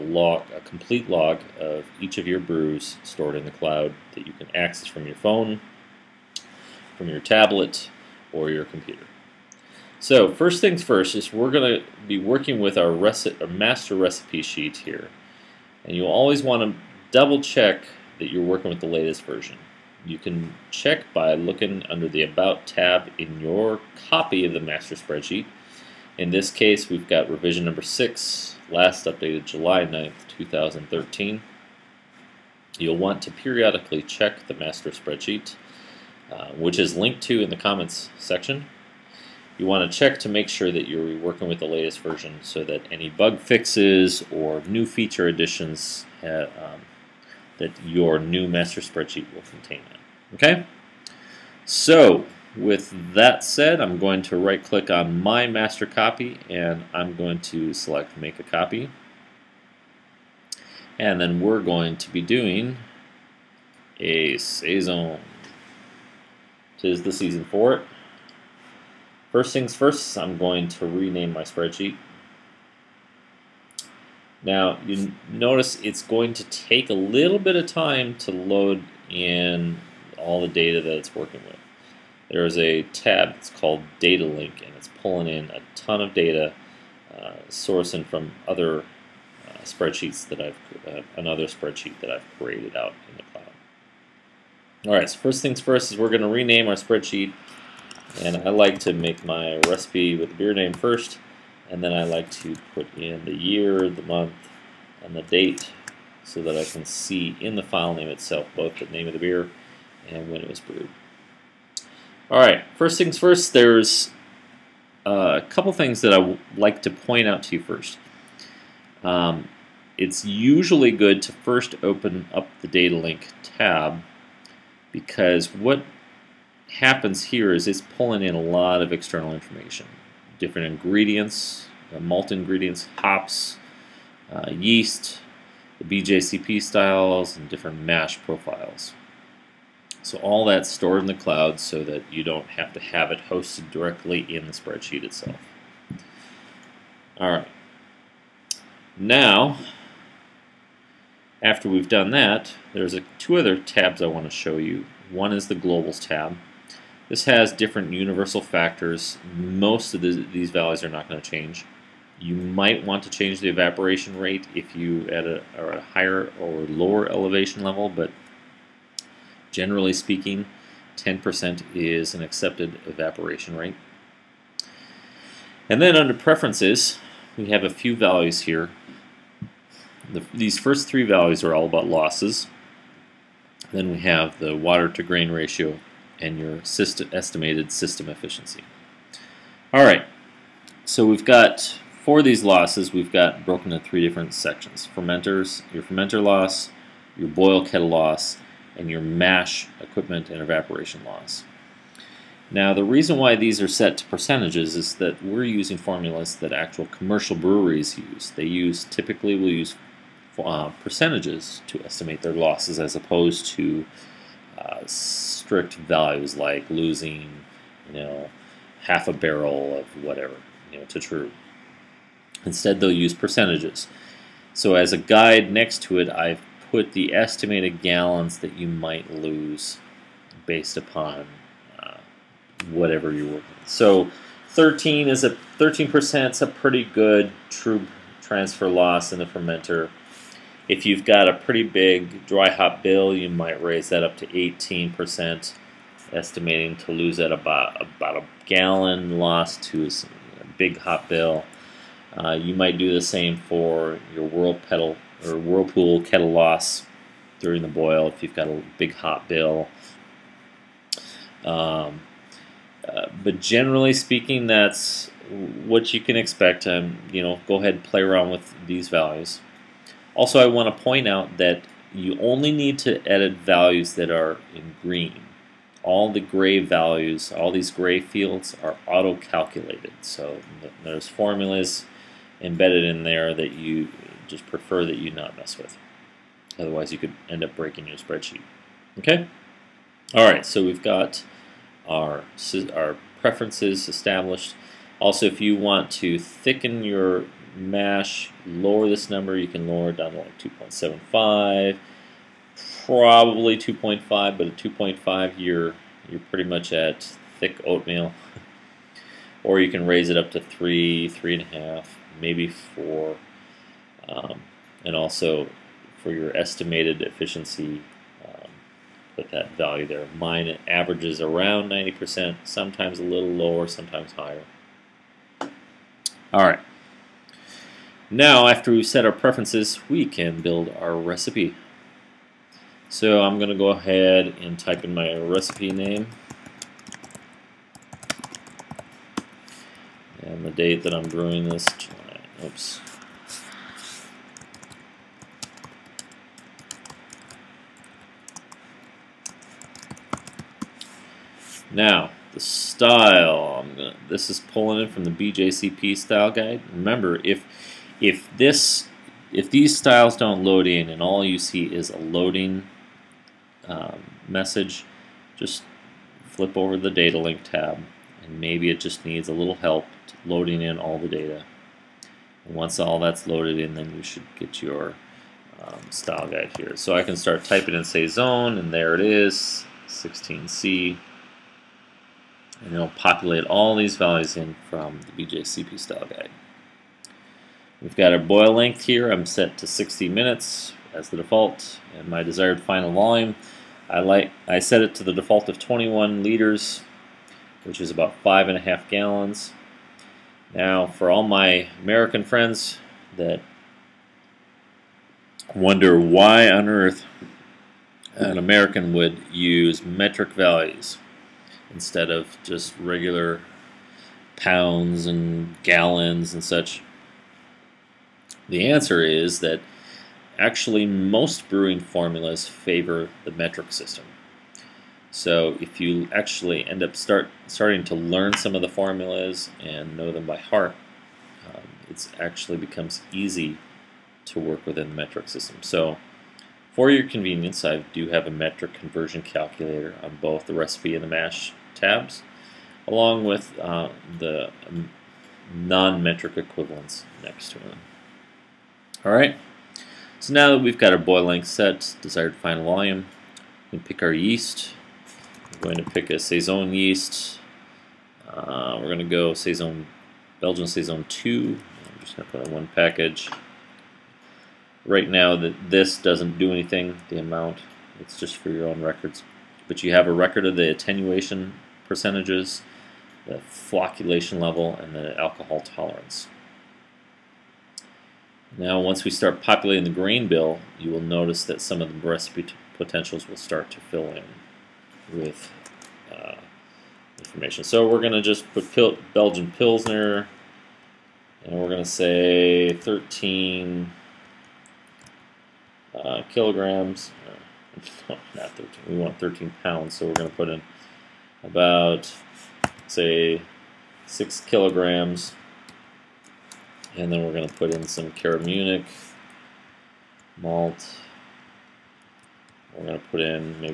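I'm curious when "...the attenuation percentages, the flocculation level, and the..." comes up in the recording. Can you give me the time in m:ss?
7:50.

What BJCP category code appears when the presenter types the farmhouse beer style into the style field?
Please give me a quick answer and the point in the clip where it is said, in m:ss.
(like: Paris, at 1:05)
16C, at 6:19.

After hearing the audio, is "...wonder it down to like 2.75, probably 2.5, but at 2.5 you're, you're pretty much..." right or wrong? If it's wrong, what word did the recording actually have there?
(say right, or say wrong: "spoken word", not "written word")
wrong: "lower", not "wonder".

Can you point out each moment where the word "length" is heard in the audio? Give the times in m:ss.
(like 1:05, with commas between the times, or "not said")
6:28, 7:31.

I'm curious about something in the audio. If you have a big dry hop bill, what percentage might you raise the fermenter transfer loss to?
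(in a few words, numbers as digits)
18%.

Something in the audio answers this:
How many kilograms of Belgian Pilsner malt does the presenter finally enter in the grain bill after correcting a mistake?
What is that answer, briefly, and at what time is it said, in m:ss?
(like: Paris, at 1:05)
6, at 8:24.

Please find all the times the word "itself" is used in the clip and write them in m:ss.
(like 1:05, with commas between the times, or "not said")
1:48, 2:25.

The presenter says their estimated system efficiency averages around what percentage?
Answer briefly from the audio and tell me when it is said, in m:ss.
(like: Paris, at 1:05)
90%, at 5:21.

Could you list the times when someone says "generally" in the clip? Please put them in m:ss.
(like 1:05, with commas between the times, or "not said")
2:49, 4:23.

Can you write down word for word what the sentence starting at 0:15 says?
And you'll always want to double check that you're working with the latest version.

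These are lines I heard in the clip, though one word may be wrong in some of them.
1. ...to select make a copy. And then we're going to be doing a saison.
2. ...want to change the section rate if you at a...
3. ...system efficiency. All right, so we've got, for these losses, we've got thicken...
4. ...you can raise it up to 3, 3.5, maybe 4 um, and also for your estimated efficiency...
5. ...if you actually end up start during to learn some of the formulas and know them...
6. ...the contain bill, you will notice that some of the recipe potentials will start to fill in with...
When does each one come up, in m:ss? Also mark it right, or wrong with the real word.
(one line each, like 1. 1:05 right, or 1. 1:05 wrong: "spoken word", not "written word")
1. 0:57 right
2. 2:42 wrong: "evaporation", not "section"
3. 3:07 wrong: "broken", not "thicken"
4. 5:09 right
5. 7:05 wrong: "starting", not "during"
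6. 7:59 wrong: "grain", not "contain".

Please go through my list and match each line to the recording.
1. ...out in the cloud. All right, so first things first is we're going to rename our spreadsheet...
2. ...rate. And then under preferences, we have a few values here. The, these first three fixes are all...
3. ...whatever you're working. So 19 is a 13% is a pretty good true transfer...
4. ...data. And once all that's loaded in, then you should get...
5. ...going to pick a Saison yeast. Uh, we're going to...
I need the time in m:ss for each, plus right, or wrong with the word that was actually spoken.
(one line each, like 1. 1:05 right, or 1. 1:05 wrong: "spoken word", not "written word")
1. 1:32 right
2. 2:53 wrong: "values", not "fixes"
3. 3:52 wrong: "13", not "19"
4. 6:11 right
5. 7:35 right.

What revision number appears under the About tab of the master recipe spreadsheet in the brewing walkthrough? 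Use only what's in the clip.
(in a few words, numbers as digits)
6.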